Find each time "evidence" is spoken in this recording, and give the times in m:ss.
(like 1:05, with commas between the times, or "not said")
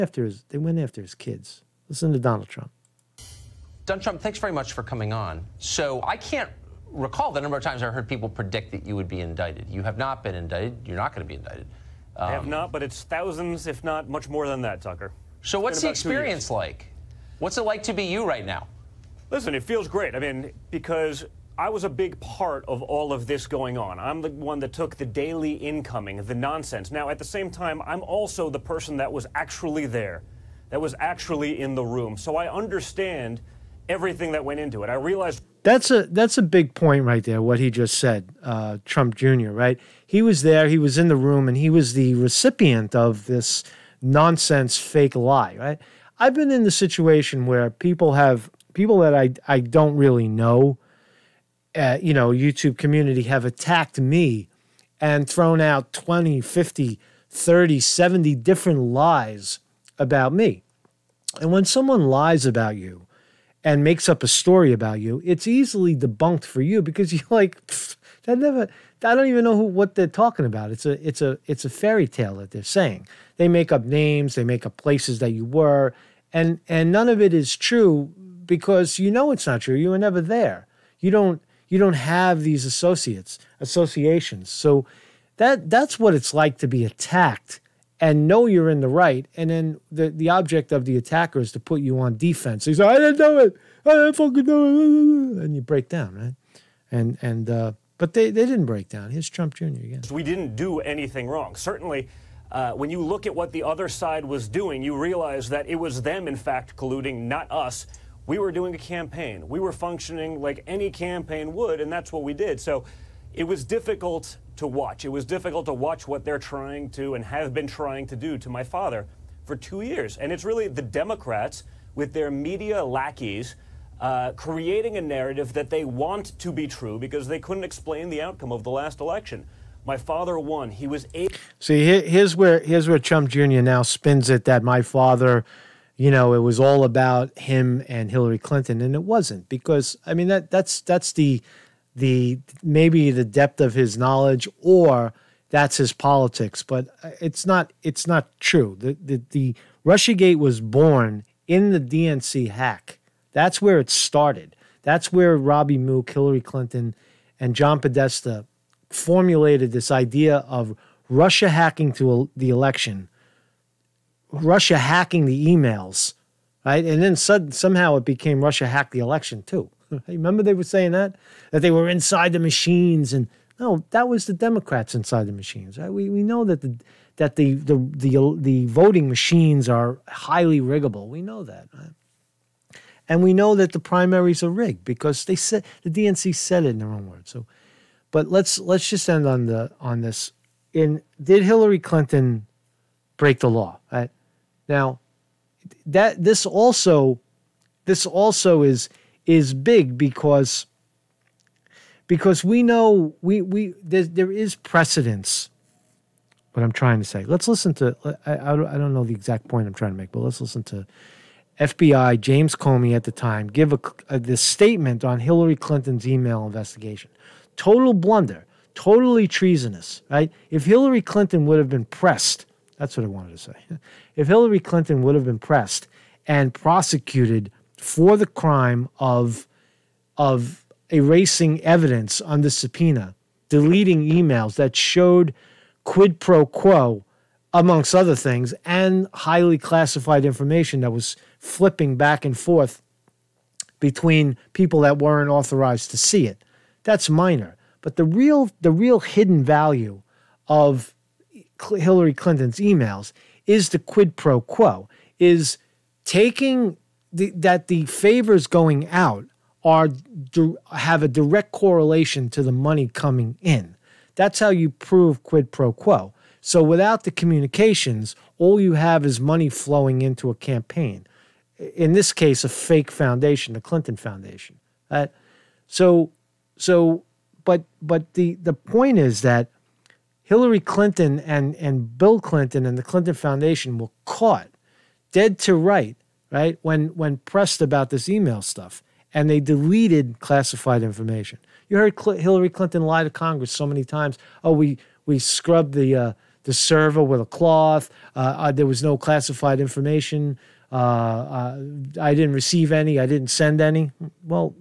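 3:51.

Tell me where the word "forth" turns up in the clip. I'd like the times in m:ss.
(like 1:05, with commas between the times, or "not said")
4:02.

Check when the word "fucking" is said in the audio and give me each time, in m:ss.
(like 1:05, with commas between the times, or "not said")
1:34.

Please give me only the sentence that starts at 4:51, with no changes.
You heard Cl Hillary Clinton lie to Congress so many times.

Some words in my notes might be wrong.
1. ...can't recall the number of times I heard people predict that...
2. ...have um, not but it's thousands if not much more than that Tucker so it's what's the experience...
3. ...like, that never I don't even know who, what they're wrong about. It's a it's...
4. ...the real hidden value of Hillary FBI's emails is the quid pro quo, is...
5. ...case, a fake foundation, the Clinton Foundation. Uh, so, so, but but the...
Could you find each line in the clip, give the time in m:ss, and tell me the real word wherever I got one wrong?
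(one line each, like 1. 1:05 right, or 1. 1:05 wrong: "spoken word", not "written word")
1. 0:06 right
2. 0:12 right
3. 1:07 wrong: "talking", not "wrong"
4. 4:08 wrong: "Clinton", not "FBI"
5. 4:32 right.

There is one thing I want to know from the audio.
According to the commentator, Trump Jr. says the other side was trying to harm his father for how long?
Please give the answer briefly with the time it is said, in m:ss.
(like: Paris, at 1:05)
2 years, at 1:59.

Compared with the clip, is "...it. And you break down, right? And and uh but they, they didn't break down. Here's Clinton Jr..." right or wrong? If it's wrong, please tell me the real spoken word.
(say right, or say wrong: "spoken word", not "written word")
wrong: "Trump", not "Clinton".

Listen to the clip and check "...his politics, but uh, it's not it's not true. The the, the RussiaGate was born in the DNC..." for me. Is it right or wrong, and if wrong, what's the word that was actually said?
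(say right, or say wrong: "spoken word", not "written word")
right.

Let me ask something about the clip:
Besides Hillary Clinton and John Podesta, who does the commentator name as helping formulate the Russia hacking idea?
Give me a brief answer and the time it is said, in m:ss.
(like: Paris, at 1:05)
Robbie Mook, at 2:35.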